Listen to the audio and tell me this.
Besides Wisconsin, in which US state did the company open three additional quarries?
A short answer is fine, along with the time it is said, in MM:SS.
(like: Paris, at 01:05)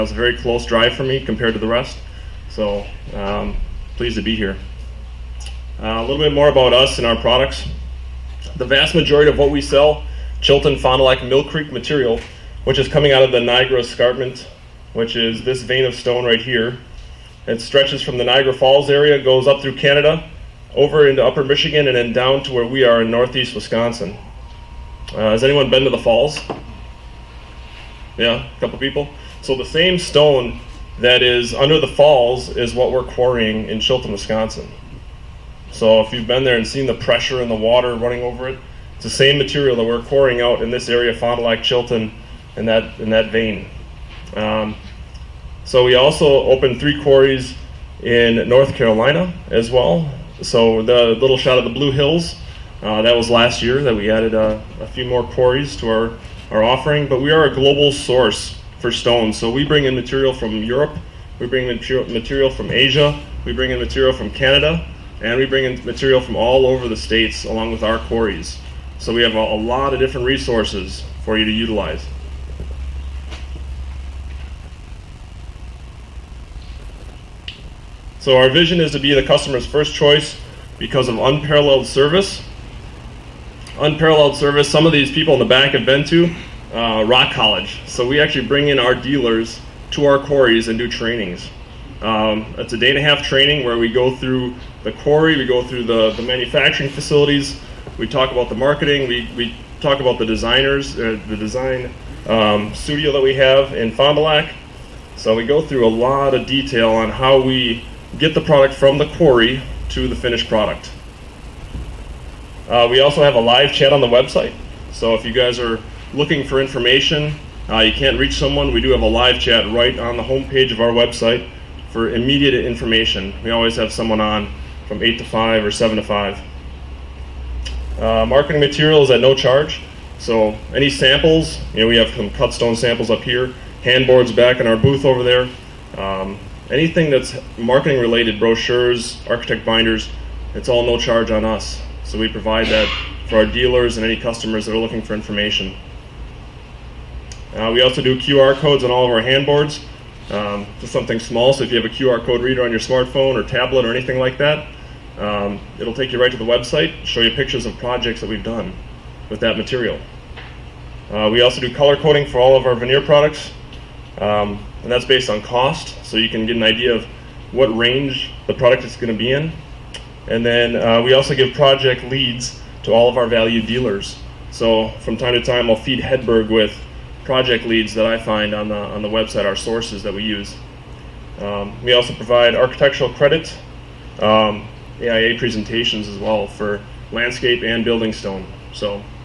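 North Carolina, at 00:48.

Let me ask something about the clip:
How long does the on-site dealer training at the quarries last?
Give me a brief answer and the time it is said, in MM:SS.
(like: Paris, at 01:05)
A day and a half, at 01:32.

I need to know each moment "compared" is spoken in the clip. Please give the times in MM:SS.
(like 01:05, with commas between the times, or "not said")
00:01.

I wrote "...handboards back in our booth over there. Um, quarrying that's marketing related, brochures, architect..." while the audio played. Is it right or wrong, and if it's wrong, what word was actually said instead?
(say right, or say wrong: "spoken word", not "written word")
wrong: "anything", not "quarrying".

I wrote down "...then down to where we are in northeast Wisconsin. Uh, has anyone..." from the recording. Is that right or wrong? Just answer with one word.
right.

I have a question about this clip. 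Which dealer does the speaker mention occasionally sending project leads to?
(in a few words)
Hedberg.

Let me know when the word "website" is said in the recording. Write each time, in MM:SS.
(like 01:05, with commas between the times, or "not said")
01:54, 02:00, 02:36, 02:59.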